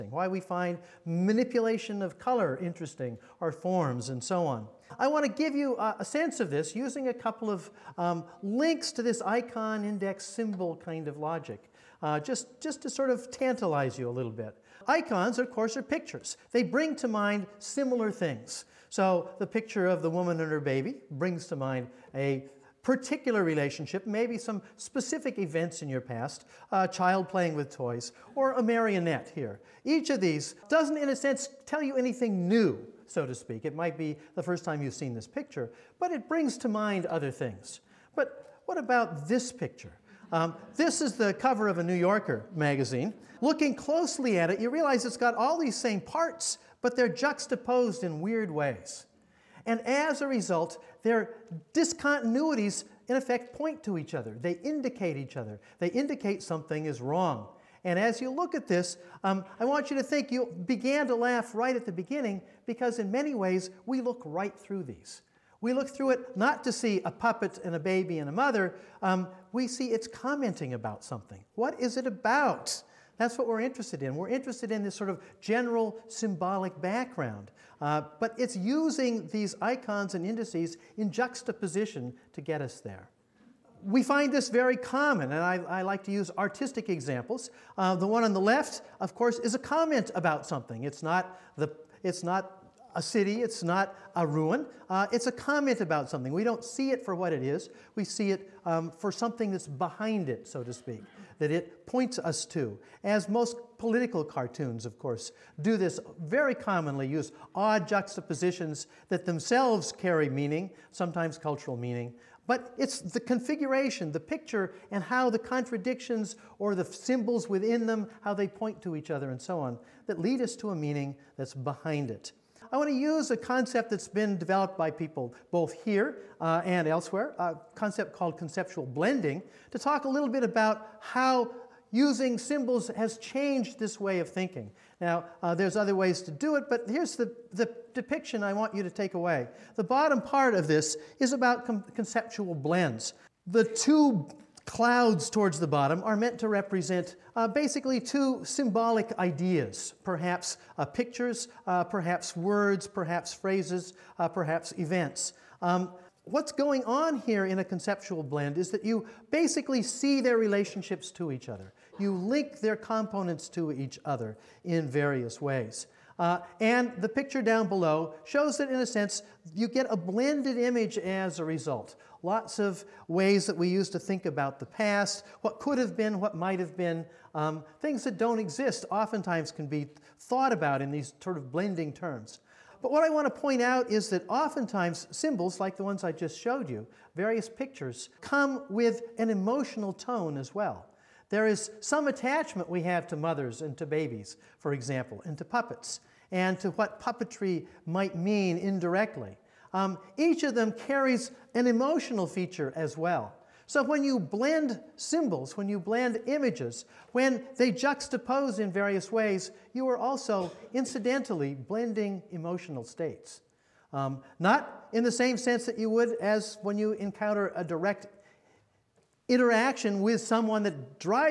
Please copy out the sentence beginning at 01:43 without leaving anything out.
As most political cartoons, of course, do this very commonly, use odd juxtapositions that themselves carry meaning, sometimes cultural meaning.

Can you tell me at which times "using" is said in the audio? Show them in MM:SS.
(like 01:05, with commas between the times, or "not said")
00:06, 01:18, 02:11.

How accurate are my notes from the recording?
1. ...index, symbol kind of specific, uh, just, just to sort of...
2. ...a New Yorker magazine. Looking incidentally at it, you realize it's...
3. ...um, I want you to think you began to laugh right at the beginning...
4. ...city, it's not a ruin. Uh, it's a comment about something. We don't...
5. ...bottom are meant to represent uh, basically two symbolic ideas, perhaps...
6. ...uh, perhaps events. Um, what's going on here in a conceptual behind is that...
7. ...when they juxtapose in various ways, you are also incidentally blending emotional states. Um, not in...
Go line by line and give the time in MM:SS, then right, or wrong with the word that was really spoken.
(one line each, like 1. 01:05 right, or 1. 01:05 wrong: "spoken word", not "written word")
1. 00:09 wrong: "logic", not "specific"
2. 00:41 wrong: "closely", not "incidentally"
3. 00:59 right
4. 01:33 right
5. 02:25 right
6. 02:34 wrong: "blend", not "behind"
7. 03:27 right.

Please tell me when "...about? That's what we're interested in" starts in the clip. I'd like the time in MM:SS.
01:12.